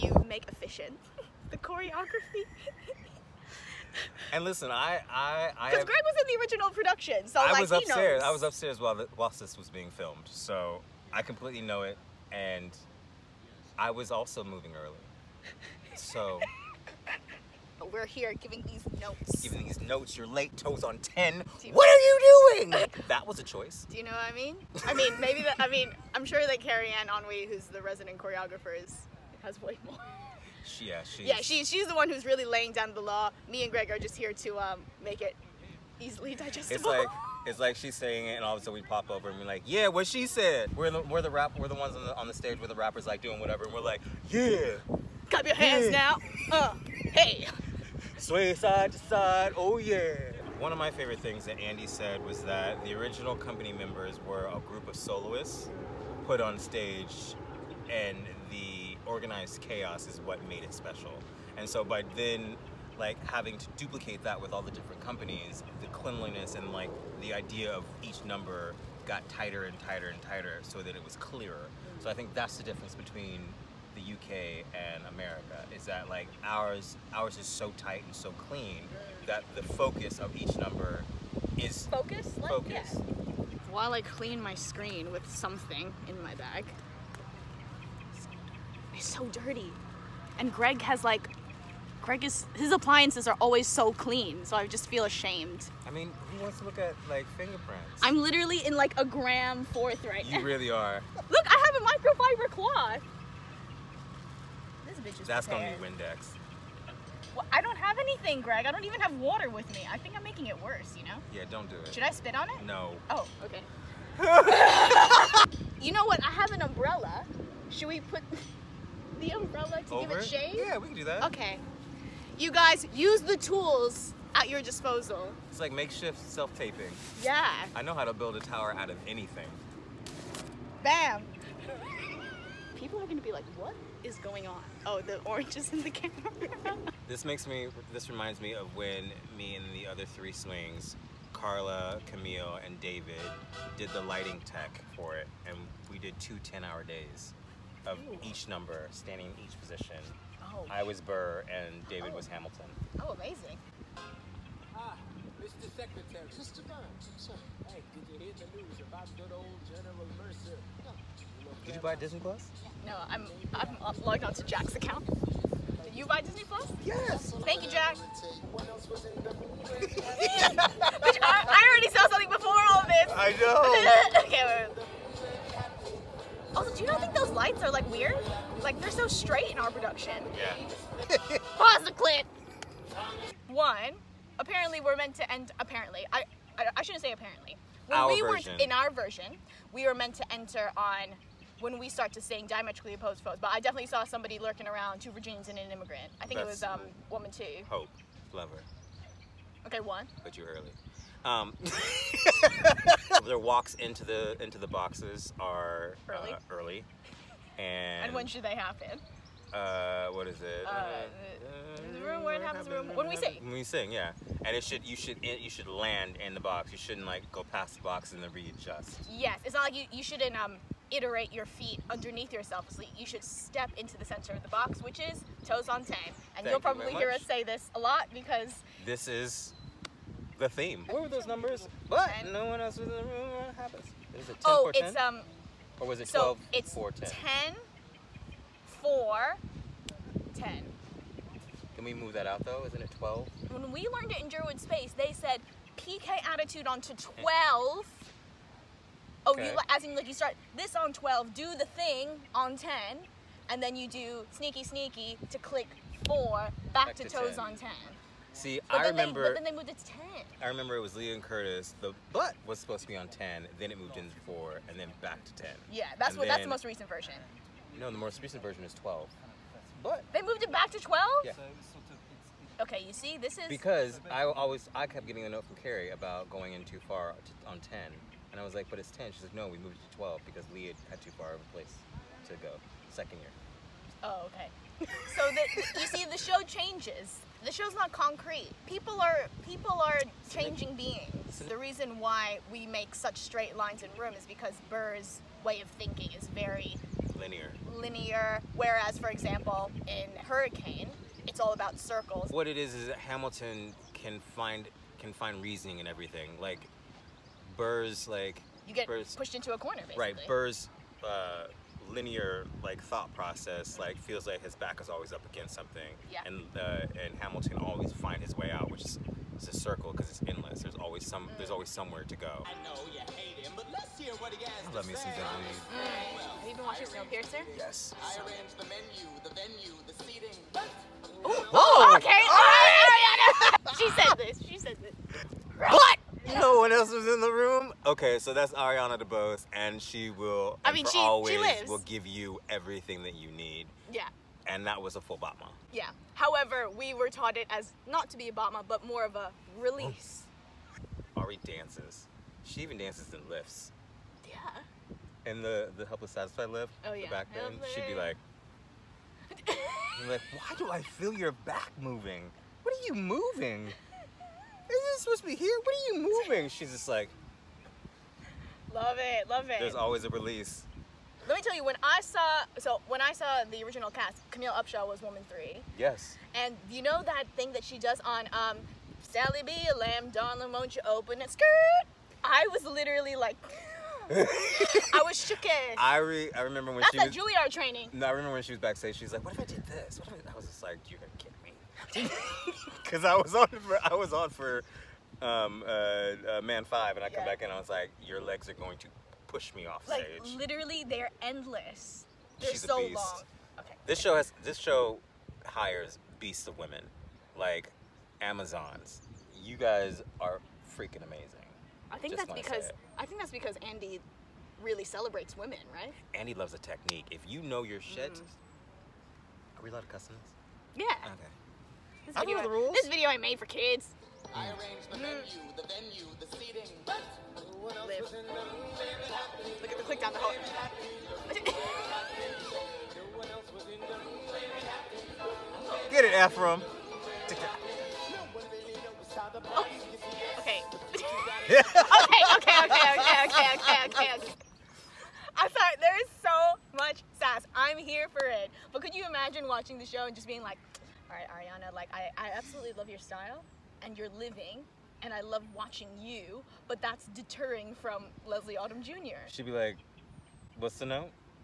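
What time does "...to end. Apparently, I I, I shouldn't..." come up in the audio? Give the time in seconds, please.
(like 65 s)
185 s.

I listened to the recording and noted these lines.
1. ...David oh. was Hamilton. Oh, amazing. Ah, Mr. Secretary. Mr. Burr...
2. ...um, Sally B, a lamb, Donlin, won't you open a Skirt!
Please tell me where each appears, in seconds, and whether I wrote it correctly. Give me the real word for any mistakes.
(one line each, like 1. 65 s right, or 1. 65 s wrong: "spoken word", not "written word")
1. 151 s right
2. 378 s right.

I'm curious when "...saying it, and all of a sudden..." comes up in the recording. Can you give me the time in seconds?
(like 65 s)
37 s.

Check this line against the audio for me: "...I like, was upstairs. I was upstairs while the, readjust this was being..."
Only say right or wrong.
wrong.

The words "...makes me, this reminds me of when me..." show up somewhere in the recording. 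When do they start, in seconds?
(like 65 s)
137 s.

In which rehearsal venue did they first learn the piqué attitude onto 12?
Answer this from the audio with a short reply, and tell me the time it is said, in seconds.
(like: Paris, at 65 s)
Jerwood Space, at 244 s.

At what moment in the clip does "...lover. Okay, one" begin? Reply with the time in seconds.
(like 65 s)
198 s.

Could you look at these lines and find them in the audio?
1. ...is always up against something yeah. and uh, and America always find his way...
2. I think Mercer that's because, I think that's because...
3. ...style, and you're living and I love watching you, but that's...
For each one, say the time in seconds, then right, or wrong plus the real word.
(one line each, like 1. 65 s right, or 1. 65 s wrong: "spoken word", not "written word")
1. 314 s wrong: "Hamilton", not "America"
2. 411 s wrong: "Just", not "Mercer"
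3. 452 s right.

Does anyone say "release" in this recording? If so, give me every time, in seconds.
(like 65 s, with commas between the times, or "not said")
349 s, 370 s.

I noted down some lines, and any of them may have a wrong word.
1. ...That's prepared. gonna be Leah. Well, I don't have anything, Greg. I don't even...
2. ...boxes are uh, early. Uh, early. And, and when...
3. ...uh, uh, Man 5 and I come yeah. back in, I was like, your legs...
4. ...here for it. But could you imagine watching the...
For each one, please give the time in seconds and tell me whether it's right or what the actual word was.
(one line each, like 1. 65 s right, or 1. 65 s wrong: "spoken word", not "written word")
1. 105 s wrong: "Windex", not "Leah"
2. 204 s right
3. 395 s right
4. 447 s right.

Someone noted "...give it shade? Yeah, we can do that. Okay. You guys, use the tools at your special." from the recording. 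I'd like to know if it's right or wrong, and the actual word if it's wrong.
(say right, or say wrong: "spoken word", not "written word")
wrong: "disposal", not "special".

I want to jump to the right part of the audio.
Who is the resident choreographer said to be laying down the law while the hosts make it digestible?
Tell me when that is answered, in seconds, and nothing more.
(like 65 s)
26 s.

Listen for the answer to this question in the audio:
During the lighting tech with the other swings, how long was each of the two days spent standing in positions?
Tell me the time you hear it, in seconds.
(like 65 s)
146 s.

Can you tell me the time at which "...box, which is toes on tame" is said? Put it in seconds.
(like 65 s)
224 s.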